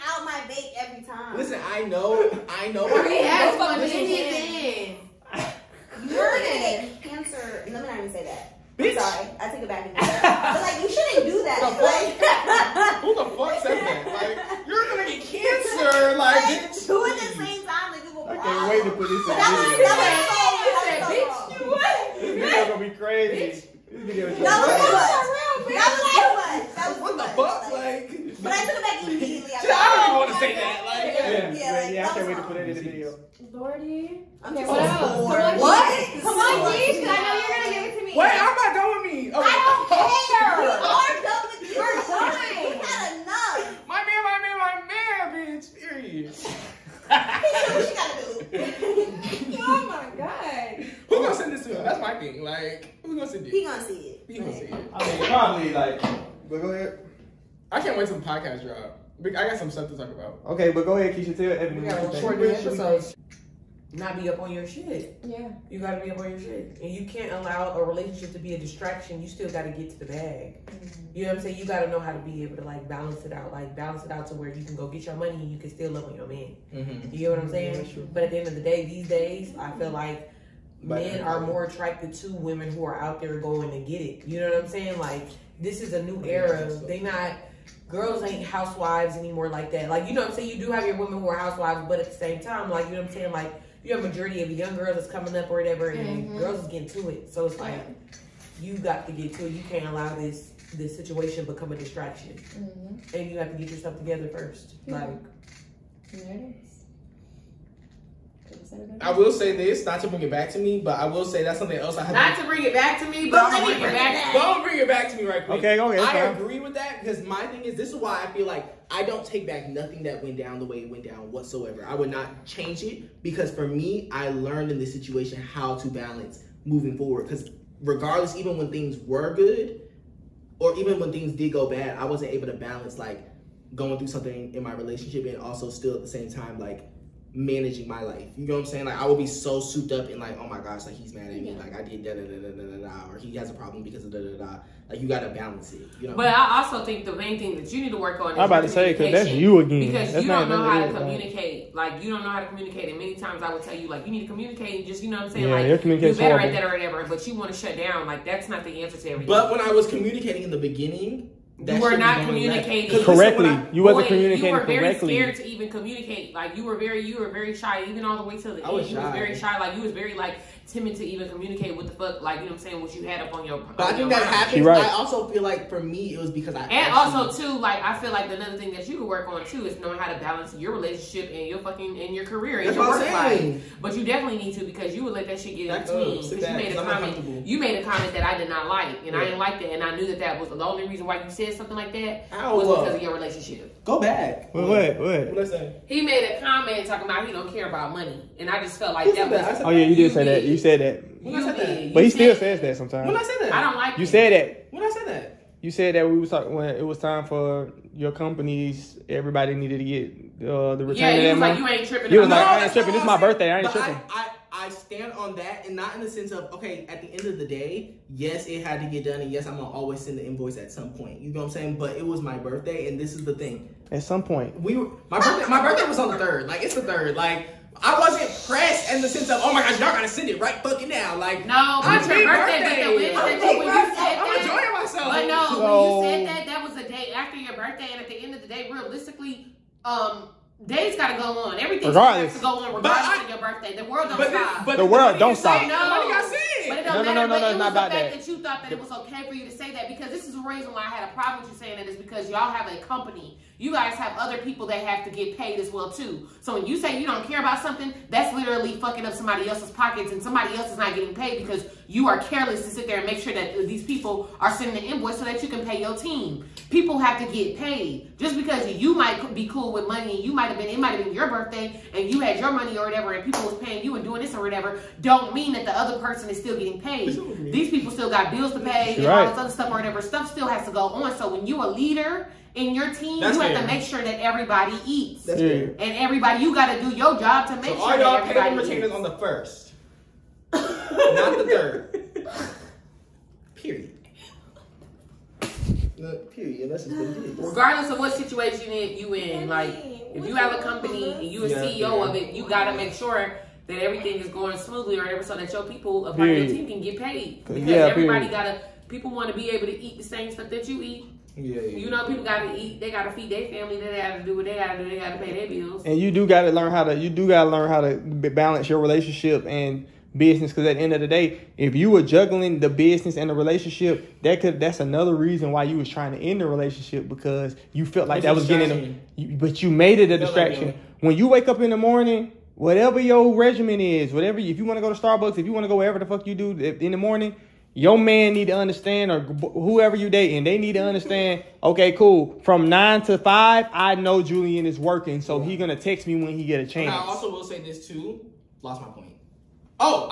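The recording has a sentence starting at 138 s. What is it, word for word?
Like I will be so souped up and like, oh my gosh, like he's mad at me.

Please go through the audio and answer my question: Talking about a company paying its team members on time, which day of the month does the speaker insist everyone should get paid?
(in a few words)
The first.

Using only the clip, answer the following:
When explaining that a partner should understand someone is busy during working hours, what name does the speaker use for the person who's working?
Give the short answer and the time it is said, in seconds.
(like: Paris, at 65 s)
Julian, at 344 s.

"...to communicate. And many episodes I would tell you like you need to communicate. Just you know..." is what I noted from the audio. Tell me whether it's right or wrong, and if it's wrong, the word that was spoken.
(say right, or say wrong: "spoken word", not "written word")
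wrong: "times", not "episodes".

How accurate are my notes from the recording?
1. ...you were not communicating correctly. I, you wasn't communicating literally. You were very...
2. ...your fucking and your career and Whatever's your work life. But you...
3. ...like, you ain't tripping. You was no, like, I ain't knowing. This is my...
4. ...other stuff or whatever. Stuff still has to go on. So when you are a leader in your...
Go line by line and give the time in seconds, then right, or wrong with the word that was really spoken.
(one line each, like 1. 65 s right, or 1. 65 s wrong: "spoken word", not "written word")
1. 161 s wrong: "correctly", not "literally"
2. 181 s wrong: "That", not "Whatever"
3. 211 s wrong: "tripping", not "knowing"
4. 279 s right.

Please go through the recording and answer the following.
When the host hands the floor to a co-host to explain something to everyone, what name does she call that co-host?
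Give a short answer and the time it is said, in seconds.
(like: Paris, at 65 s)
Keisha, at 61 s.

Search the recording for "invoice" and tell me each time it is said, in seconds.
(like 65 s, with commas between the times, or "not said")
220 s, 264 s.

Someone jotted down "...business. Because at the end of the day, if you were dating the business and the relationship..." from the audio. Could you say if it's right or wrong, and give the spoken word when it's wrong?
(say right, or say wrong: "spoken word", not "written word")
wrong: "juggling", not "dating".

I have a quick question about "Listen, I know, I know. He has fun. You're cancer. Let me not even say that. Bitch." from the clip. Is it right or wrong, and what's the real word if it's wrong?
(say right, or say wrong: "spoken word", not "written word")
right.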